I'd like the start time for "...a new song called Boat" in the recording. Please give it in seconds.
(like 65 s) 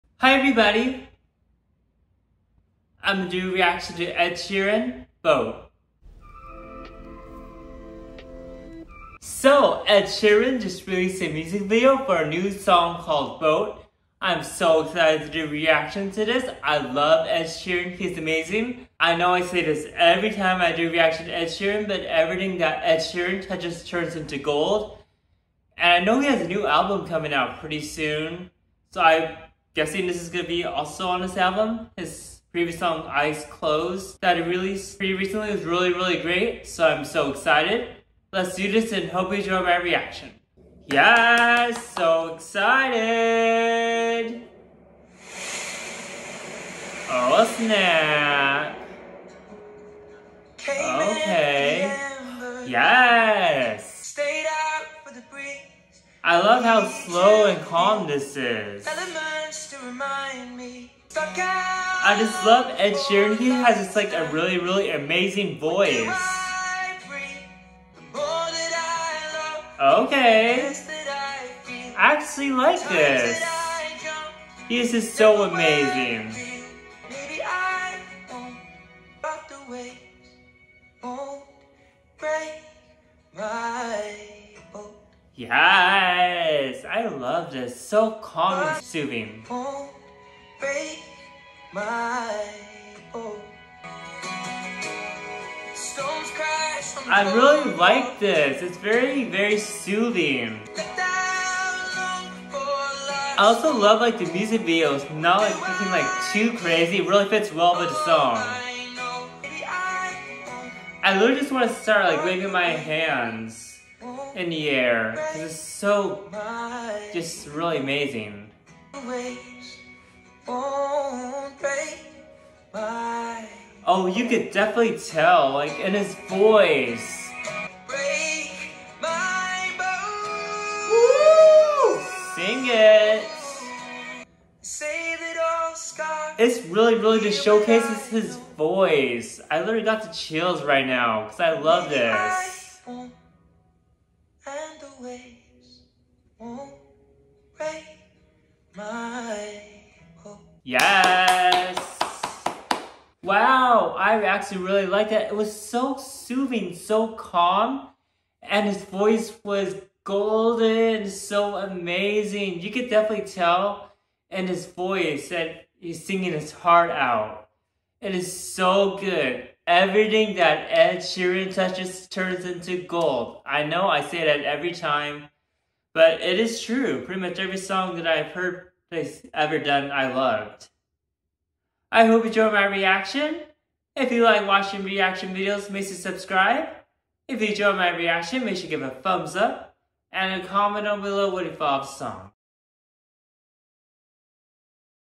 12 s.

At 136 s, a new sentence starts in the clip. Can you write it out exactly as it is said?
It's really, really just showcases his voice.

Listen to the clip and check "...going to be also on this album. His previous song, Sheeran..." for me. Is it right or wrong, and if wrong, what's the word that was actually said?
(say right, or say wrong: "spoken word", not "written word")
wrong: "Eyes", not "Sheeran".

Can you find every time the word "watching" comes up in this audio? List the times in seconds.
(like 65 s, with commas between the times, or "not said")
184 s.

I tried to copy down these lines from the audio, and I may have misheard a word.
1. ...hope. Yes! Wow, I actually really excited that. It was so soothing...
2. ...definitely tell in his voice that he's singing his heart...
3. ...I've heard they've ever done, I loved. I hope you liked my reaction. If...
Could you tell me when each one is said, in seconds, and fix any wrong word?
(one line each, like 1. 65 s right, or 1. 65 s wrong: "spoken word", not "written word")
1. 150 s wrong: "liked", not "excited"
2. 162 s right
3. 178 s wrong: "enjoyed", not "liked".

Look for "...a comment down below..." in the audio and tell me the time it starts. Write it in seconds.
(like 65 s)
190 s.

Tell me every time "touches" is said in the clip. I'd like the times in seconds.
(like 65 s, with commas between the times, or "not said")
23 s, 171 s.